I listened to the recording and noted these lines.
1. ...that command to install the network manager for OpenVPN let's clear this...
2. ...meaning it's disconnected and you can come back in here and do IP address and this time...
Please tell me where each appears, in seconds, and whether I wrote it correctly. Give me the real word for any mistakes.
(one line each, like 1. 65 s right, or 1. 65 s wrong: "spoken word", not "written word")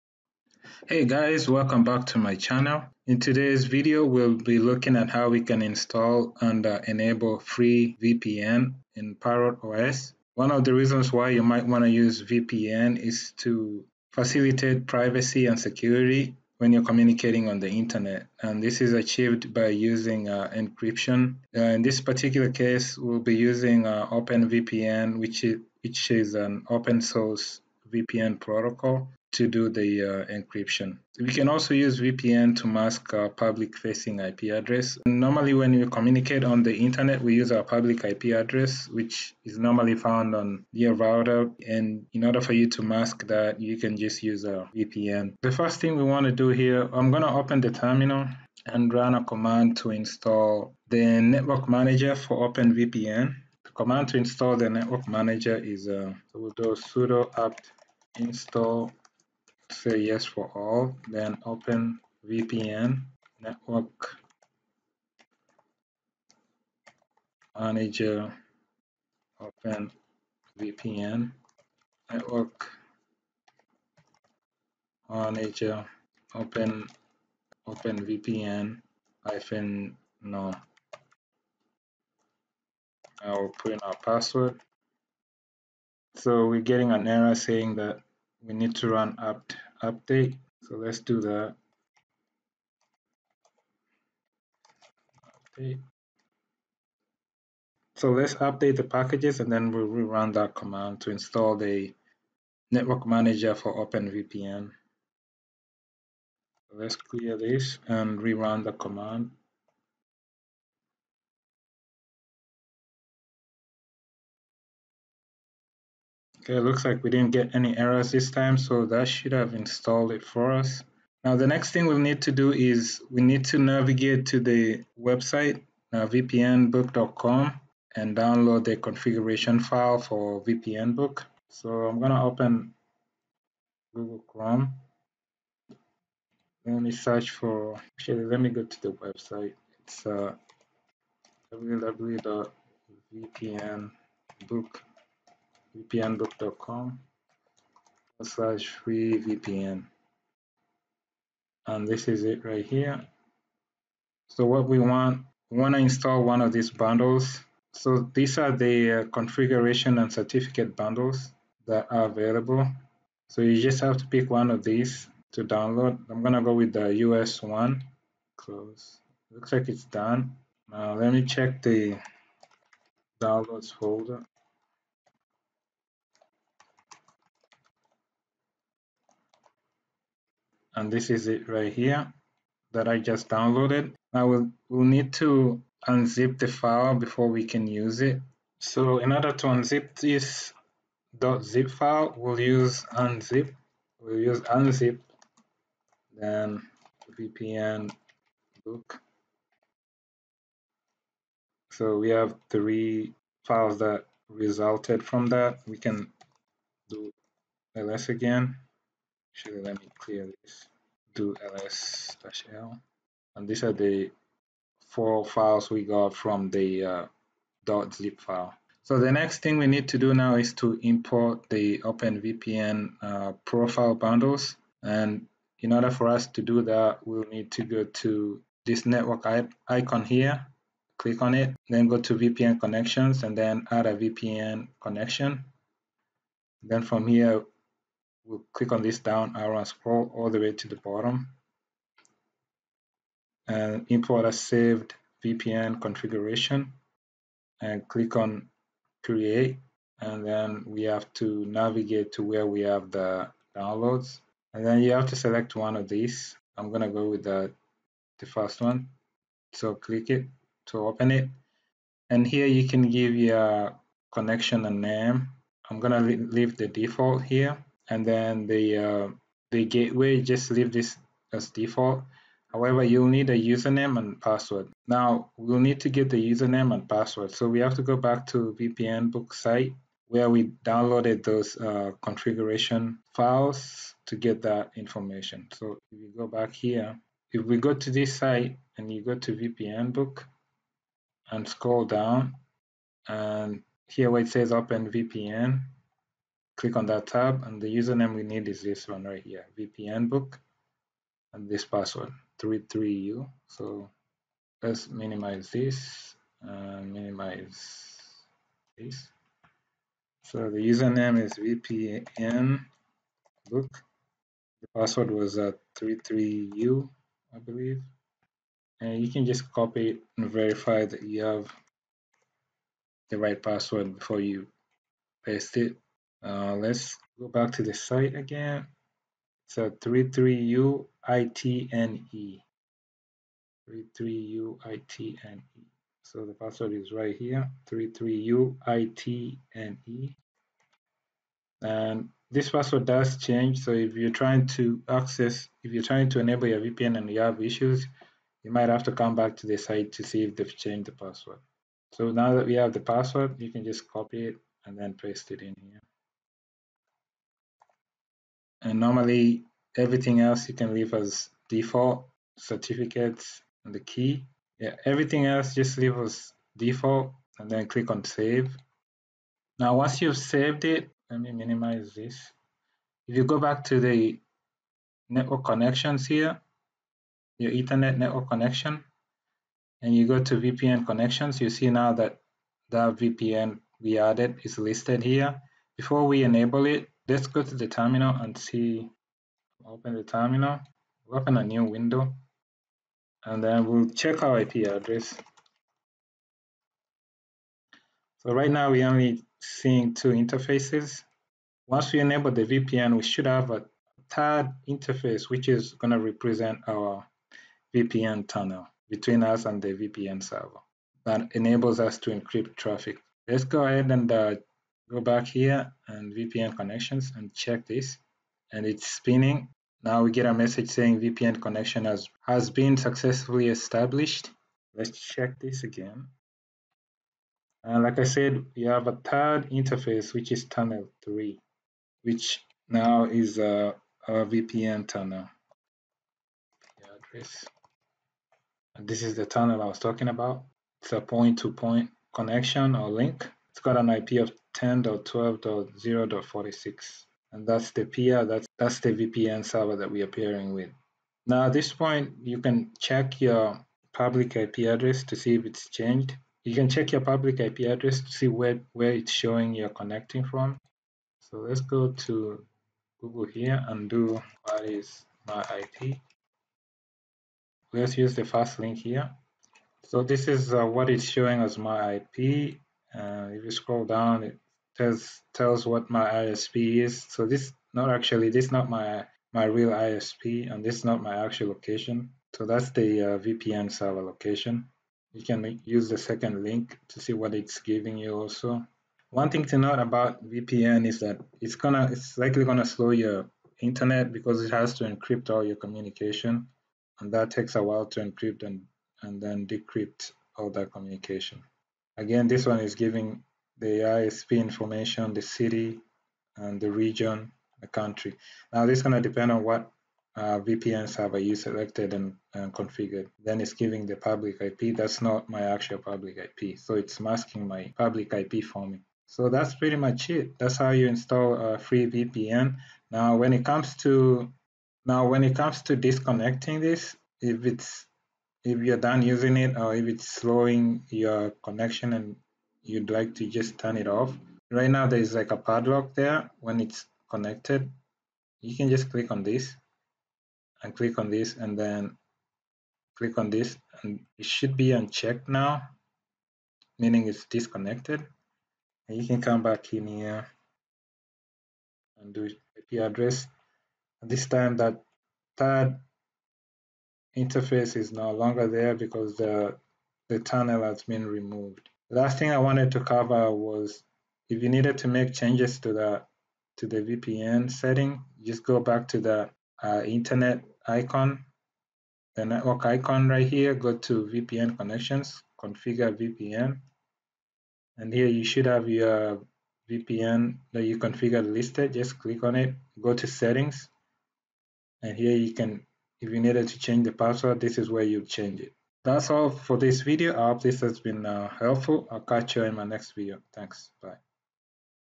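1. 100 s right
2. 546 s right.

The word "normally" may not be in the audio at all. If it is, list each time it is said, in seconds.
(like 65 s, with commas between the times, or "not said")
35 s, 39 s, 358 s.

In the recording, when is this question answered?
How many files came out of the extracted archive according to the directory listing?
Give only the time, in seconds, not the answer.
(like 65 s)
214 s.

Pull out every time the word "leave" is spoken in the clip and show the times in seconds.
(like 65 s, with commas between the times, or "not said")
266 s, 270 s, 360 s, 365 s.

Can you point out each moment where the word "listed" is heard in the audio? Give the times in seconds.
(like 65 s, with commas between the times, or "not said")
384 s, 581 s.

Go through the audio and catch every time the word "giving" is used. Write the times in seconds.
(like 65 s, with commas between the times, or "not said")
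487 s, 502 s, 513 s.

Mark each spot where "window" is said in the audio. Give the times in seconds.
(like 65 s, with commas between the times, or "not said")
391 s.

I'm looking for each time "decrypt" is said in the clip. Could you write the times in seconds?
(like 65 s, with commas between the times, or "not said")
499 s.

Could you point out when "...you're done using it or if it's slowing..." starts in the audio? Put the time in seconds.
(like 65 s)
528 s.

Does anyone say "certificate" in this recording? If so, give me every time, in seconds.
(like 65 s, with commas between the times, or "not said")
160 s, 362 s.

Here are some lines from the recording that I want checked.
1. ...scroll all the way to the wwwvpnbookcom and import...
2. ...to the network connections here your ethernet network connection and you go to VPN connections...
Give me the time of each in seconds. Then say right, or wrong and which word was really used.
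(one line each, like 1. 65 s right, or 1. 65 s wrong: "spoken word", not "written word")
1. 239 s wrong: "bottom", not "wwwvpnbookcom"
2. 373 s right.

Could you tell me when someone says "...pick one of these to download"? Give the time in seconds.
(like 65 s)
164 s.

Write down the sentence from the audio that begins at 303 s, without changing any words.
So let's minimize this and minimize this.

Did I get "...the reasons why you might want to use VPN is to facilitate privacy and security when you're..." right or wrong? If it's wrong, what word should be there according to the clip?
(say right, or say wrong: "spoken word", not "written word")
right.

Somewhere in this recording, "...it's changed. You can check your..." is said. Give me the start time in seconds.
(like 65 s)
455 s.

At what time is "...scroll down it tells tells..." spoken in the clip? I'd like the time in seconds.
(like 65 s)
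473 s.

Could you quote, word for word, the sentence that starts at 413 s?
Let's go ahead and uh, go back here and VPN connections and check this and it's spinning.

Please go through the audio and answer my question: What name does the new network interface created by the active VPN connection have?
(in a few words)
tunnel 3.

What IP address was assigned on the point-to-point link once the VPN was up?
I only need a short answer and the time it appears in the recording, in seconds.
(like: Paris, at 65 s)
10.12.0.46, at 444 s.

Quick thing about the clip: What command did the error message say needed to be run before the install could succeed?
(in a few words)
apt update.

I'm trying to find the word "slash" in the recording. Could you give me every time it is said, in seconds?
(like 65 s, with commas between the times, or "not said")
148 s, 212 s.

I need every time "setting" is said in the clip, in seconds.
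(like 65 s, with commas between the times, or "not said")
567 s, 583 s.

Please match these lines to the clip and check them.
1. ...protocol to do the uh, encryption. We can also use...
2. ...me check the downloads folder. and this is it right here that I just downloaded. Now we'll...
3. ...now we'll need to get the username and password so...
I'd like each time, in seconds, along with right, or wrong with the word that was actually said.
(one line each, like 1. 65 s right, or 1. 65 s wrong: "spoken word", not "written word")
1. 28 s right
2. 171 s right
3. 274 s right.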